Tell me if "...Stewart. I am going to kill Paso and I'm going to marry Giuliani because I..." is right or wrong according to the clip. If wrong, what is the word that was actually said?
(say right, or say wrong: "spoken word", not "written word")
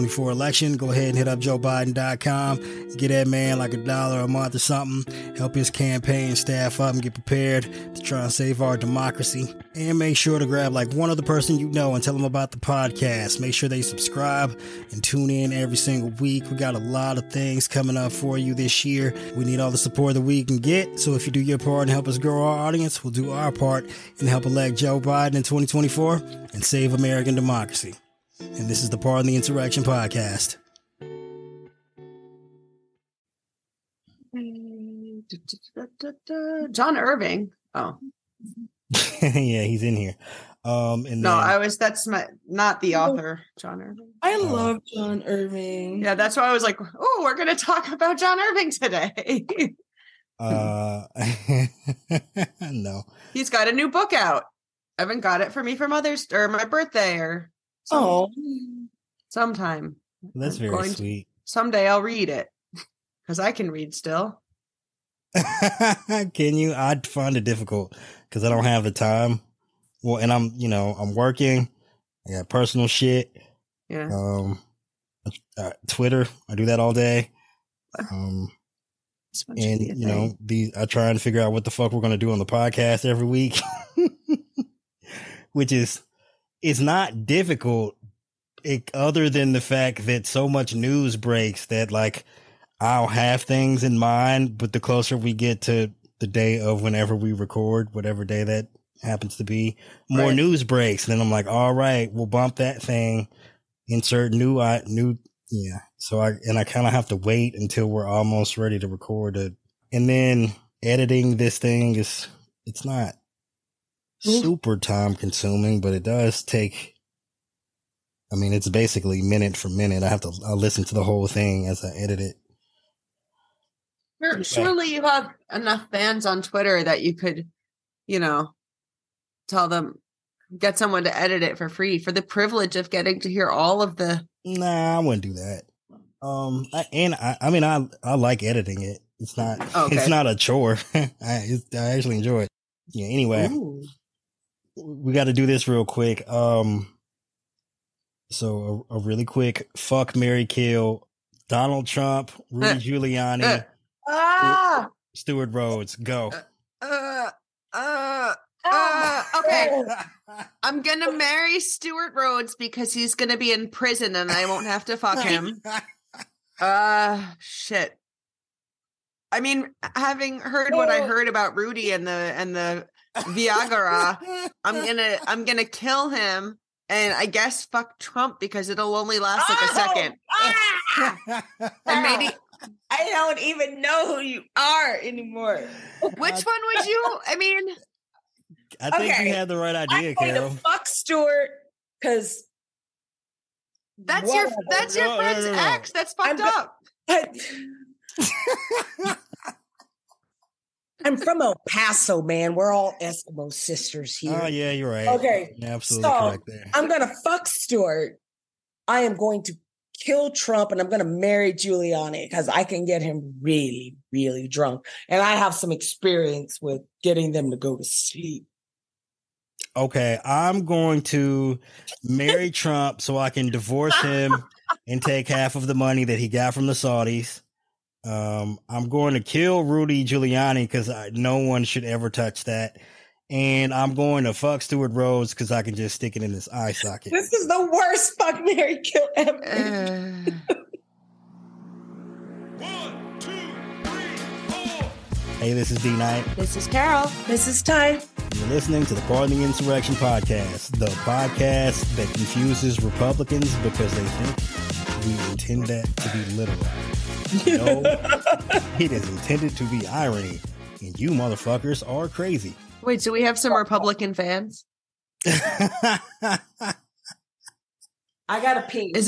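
wrong: "Trump", not "Paso".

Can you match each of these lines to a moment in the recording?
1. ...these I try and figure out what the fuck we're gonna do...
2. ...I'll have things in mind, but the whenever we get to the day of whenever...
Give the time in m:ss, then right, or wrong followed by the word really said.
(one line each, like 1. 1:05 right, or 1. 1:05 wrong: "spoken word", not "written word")
1. 1:20 right
2. 1:32 wrong: "closer", not "whenever".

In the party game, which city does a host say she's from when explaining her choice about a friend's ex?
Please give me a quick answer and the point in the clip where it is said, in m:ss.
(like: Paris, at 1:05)
El Paso, at 3:21.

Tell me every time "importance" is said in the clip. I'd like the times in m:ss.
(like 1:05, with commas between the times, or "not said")
not said.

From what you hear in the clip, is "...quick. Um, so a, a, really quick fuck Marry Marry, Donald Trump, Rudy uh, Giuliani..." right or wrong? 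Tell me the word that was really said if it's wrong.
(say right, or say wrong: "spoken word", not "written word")
wrong: "Kill", not "Marry".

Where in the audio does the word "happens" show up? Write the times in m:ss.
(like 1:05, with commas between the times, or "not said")
1:39.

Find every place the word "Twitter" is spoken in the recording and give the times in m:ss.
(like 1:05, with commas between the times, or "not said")
1:15, 2:06.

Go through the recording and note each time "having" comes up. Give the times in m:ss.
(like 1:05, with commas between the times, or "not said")
2:49.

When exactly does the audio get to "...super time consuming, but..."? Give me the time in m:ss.
1:54.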